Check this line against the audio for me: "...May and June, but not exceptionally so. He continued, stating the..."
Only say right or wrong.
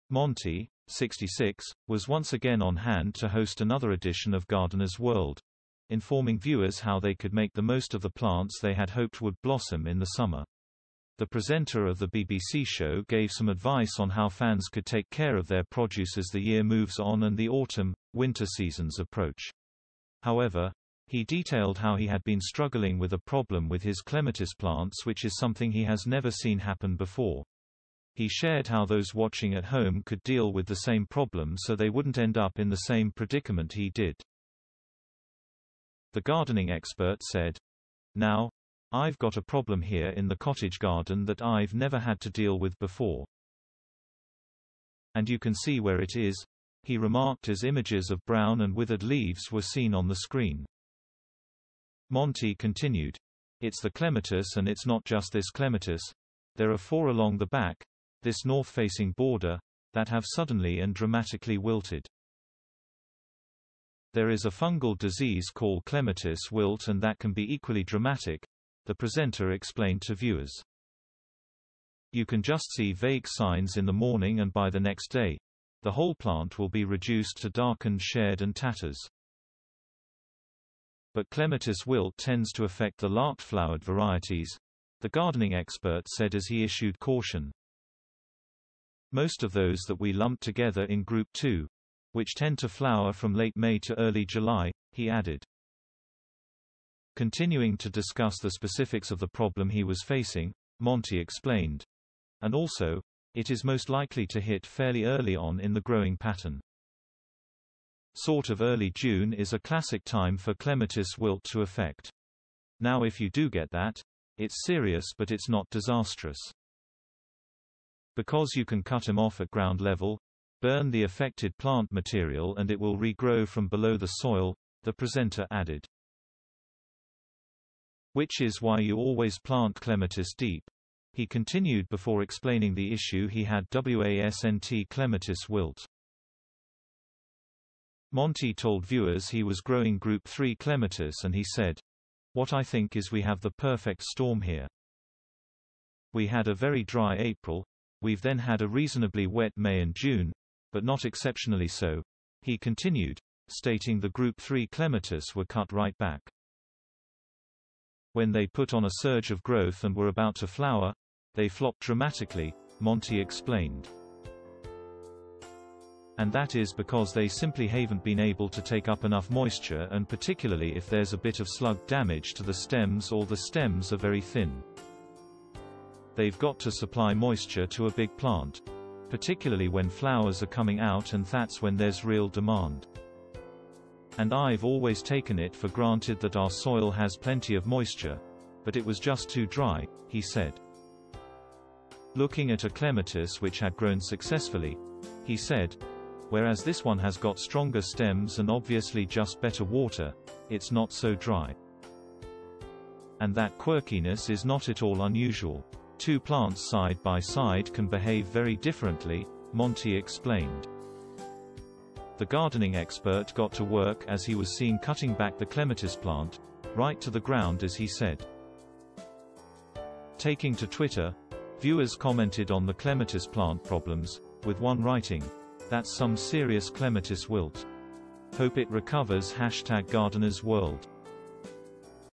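right.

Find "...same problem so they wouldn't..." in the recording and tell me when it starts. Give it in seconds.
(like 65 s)
30 s.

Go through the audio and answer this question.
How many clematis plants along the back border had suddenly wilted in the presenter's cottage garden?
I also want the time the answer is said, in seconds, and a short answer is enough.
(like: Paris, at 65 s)
4, at 56 s.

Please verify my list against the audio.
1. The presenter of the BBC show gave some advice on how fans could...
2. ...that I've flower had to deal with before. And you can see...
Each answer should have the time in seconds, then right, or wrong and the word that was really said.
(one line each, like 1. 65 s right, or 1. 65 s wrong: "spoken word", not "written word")
1. 11 s right
2. 41 s wrong: "never", not "flower".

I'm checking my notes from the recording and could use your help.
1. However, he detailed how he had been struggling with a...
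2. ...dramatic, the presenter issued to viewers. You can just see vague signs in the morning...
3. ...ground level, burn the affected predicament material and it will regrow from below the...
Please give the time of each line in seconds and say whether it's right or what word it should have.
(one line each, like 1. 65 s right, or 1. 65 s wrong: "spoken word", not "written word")
1. 20 s right
2. 67 s wrong: "explained", not "issued"
3. 119 s wrong: "plant", not "predicament".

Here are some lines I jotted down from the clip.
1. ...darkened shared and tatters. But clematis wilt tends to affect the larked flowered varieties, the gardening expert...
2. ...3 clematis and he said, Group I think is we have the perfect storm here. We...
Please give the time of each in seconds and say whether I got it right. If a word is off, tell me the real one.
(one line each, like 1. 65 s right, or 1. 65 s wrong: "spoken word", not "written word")
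1. 77 s right
2. 140 s wrong: "What", not "Group".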